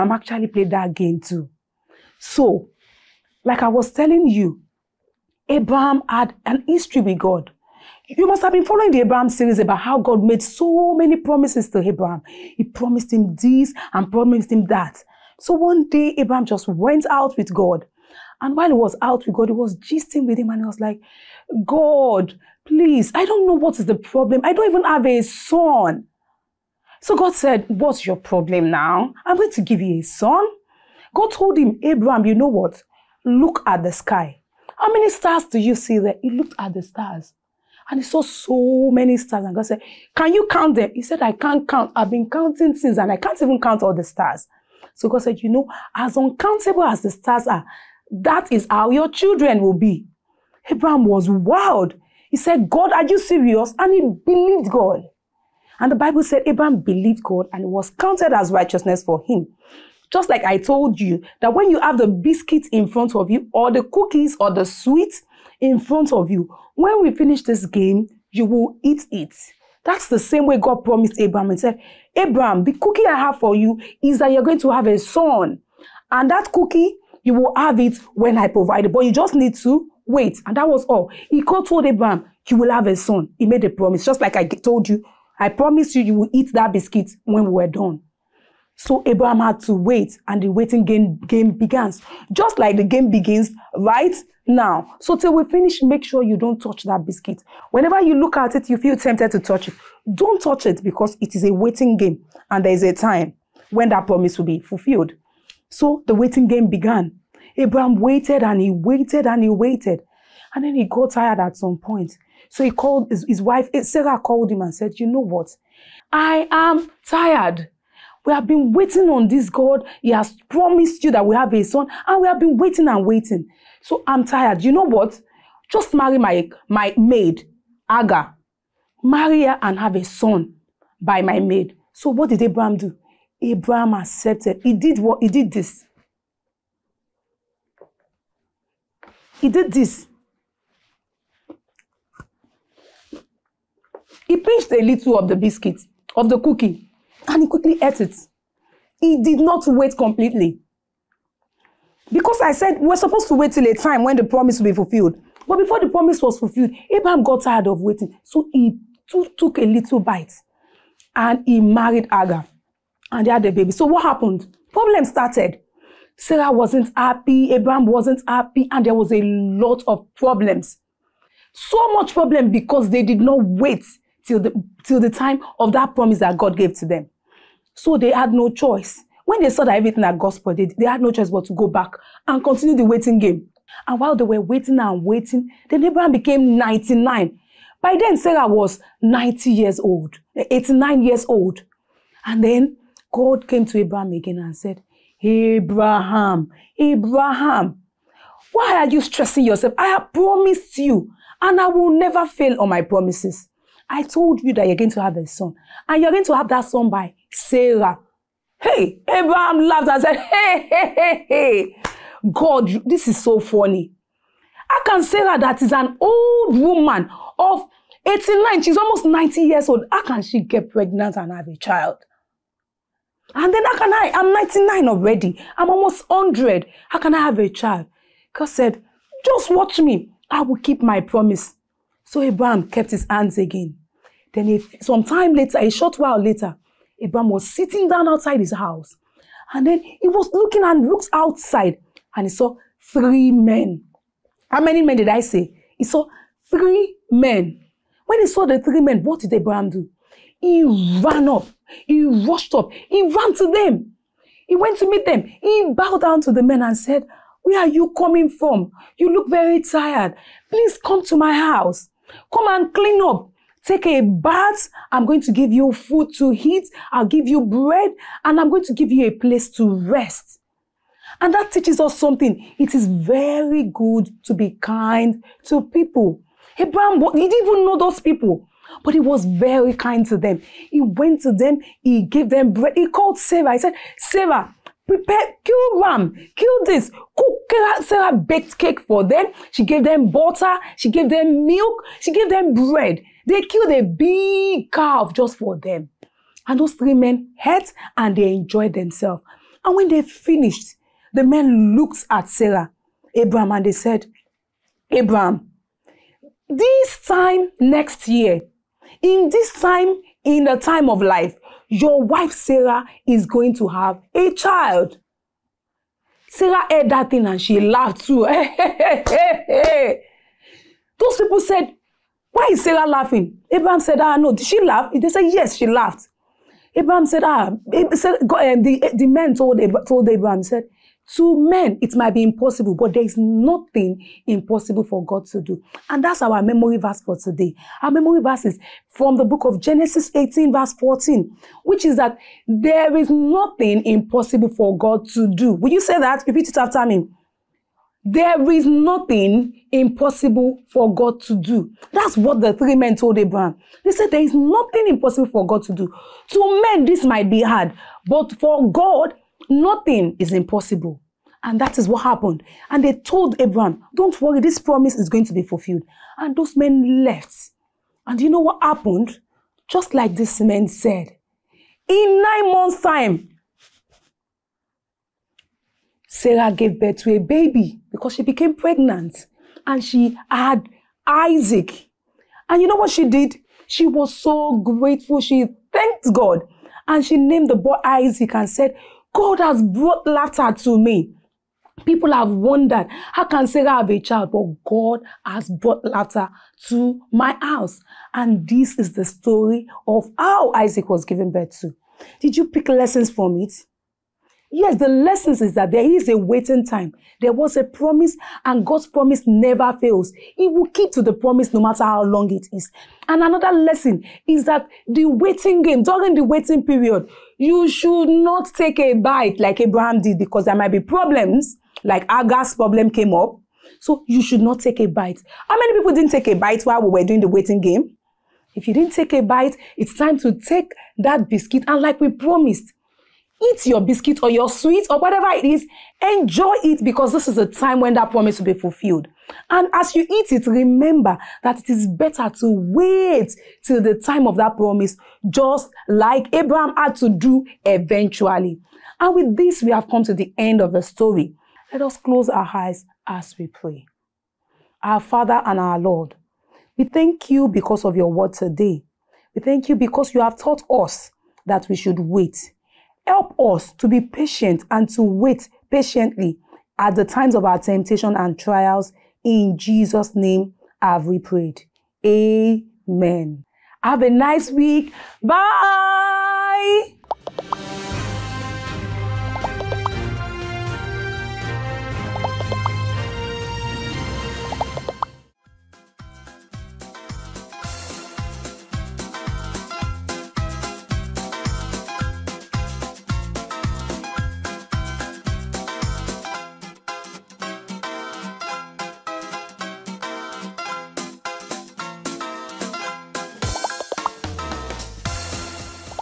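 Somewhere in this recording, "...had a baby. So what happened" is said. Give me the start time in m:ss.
2:43.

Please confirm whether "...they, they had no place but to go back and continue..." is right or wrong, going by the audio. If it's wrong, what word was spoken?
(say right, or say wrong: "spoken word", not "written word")
wrong: "choice", not "place".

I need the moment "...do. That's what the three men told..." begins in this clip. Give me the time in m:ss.
5:51.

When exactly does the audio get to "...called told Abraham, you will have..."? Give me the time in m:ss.
1:21.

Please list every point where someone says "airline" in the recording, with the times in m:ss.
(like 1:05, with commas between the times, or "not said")
not said.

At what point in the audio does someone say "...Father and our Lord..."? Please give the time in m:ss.
7:34.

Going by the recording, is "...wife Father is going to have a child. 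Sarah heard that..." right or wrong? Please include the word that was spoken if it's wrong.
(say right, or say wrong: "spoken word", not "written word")
wrong: "Sarah", not "Father".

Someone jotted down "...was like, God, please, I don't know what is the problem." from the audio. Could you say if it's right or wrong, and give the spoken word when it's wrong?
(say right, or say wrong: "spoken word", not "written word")
right.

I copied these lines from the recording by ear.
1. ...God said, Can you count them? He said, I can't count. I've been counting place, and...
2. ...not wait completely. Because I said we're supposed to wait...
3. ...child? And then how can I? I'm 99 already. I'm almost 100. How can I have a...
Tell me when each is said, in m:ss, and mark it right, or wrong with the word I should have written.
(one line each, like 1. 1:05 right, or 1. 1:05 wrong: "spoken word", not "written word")
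1. 0:39 wrong: "since", not "place"
2. 2:29 right
3. 3:41 right.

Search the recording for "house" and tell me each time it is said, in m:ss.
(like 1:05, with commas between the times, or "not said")
3:58, 4:21, 6:37.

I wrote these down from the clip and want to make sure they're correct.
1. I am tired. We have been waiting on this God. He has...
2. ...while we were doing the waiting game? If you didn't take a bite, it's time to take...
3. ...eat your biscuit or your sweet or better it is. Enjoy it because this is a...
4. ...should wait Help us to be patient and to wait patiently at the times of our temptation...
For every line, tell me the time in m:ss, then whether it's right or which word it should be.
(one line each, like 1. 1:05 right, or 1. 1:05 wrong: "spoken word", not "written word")
1. 1:56 right
2. 7:06 right
3. 7:13 wrong: "whatever", not "better"
4. 7:41 right.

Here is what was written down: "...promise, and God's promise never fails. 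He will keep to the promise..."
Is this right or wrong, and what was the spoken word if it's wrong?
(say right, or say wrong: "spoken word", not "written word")
right.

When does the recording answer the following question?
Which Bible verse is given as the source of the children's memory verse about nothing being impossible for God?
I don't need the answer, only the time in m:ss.
5:39.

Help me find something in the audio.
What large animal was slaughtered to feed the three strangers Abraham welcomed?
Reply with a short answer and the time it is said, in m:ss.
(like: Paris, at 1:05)
a big calf, at 4:53.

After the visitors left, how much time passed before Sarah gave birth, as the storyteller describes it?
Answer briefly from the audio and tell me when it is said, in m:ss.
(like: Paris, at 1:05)
9 months, at 6:12.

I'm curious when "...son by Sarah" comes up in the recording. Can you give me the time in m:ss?
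3:26.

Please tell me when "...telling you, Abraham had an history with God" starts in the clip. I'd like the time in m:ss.
0:03.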